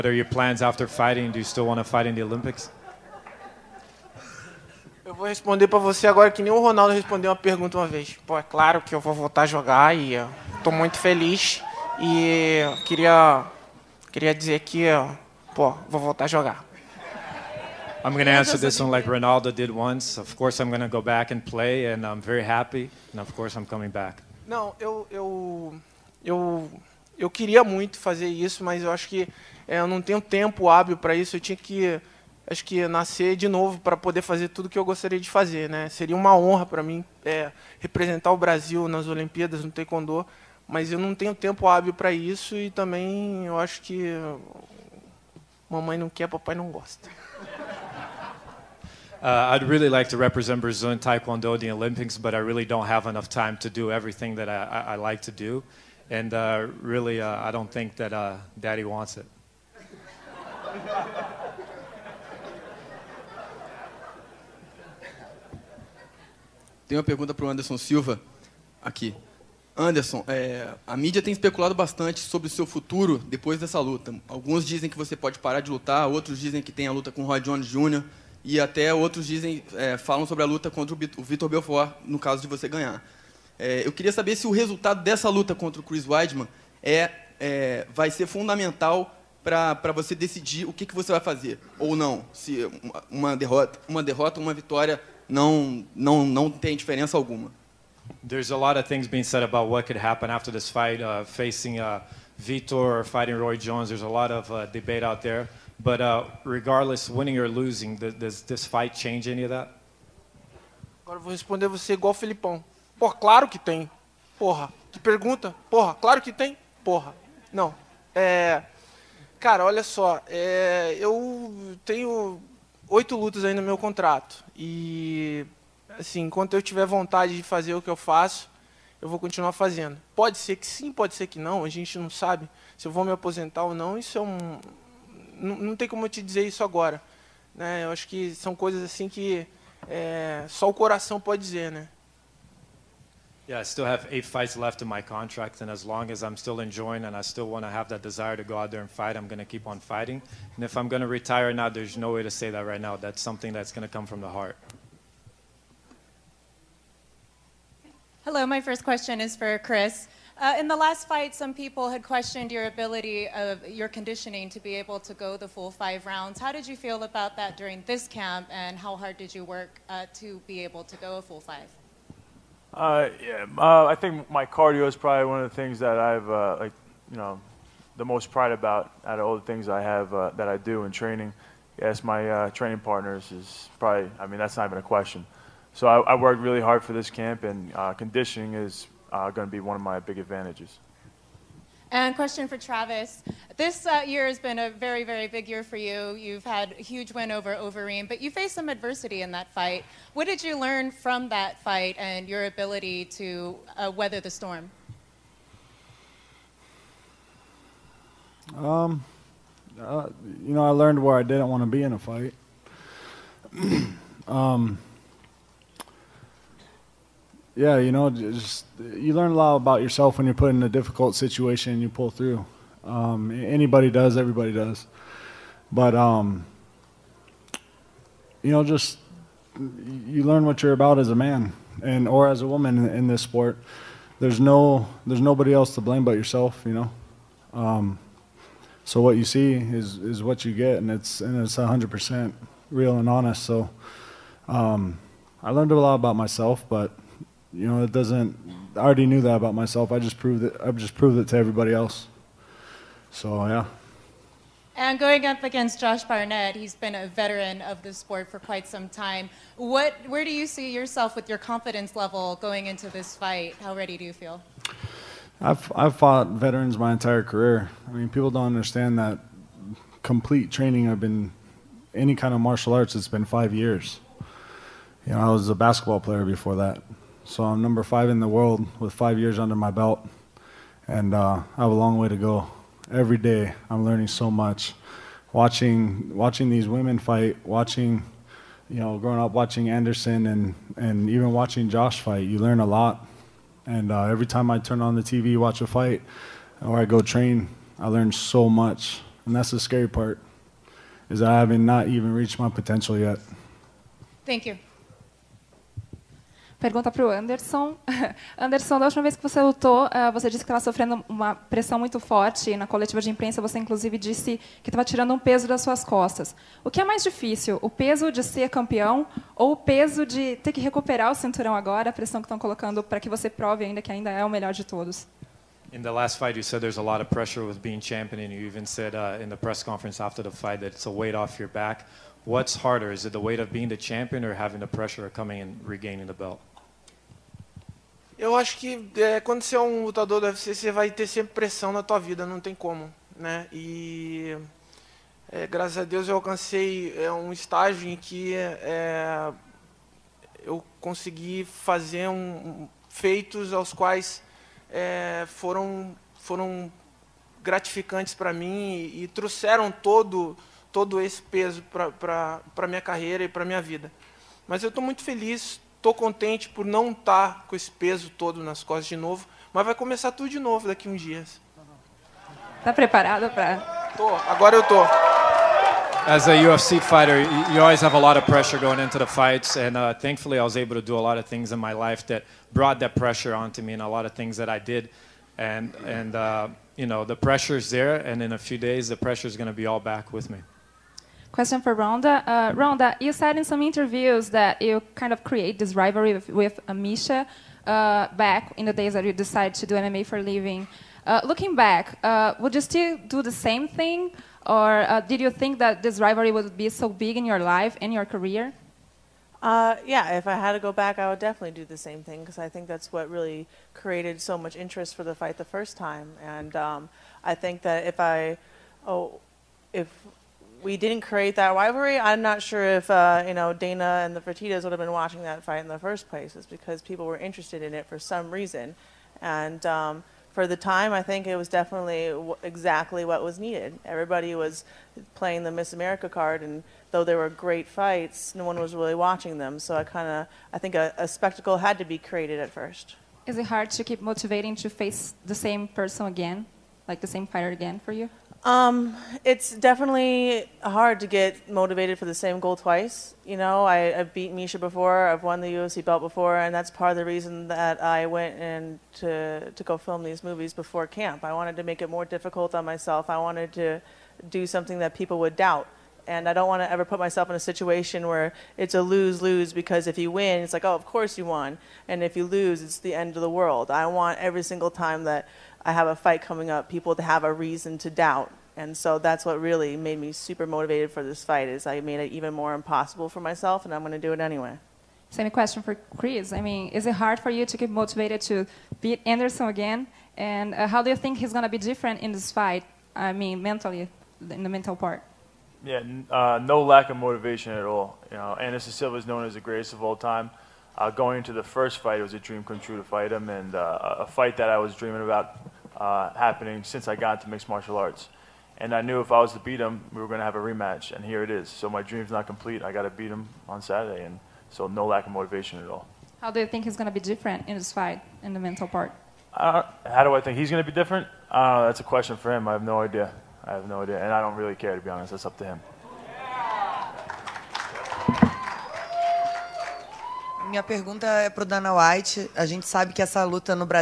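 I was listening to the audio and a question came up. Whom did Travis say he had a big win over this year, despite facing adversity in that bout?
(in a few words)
Overeem.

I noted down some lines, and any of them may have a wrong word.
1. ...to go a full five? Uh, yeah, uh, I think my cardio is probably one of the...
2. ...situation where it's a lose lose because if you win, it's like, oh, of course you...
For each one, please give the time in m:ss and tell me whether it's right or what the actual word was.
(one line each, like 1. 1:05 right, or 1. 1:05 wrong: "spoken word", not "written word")
1. 2:50 right
2. 7:47 right.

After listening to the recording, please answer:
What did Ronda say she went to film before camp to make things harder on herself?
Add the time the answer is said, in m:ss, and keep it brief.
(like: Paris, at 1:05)
Movies, at 7:40.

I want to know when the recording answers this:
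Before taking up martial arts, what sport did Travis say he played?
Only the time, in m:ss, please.
4:35.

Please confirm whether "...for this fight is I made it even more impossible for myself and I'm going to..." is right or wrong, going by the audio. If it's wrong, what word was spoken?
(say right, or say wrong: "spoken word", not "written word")
right.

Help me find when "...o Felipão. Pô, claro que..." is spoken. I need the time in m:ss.
1:52.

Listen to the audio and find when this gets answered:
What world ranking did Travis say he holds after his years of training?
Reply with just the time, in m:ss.
4:37.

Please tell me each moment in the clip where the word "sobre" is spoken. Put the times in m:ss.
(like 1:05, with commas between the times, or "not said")
1:12, 1:20.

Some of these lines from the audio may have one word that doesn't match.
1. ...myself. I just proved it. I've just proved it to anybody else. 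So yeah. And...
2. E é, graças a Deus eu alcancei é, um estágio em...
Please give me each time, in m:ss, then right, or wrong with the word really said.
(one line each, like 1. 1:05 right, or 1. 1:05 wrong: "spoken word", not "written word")
1. 4:09 wrong: "everybody", not "anybody"
2. 5:43 right.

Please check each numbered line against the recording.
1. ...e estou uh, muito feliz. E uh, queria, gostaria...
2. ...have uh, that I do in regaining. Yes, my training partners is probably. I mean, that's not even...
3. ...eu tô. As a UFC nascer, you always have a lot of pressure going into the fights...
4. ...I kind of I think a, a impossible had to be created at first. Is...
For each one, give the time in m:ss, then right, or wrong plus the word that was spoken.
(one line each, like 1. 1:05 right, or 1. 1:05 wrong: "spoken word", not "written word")
1. 0:09 wrong: "queria", not "gostaria"
2. 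2:59 wrong: "training", not "regaining"
3. 6:14 wrong: "fighter", not "nascer"
4. 7:19 wrong: "spectacle", not "impossible".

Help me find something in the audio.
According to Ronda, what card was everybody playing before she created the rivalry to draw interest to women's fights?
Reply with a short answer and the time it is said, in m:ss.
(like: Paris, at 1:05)
Miss America, at 7:15.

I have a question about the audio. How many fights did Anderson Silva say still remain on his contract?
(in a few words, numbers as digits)
8.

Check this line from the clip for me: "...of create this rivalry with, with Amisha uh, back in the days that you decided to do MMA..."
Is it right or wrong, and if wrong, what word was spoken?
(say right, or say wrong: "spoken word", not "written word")
right.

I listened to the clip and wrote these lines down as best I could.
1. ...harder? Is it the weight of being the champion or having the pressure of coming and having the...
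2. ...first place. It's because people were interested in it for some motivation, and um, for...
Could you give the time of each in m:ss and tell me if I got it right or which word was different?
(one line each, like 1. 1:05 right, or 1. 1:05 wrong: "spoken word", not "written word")
1. 5:32 wrong: "regaining", not "having"
2. 7:05 wrong: "reason", not "motivation".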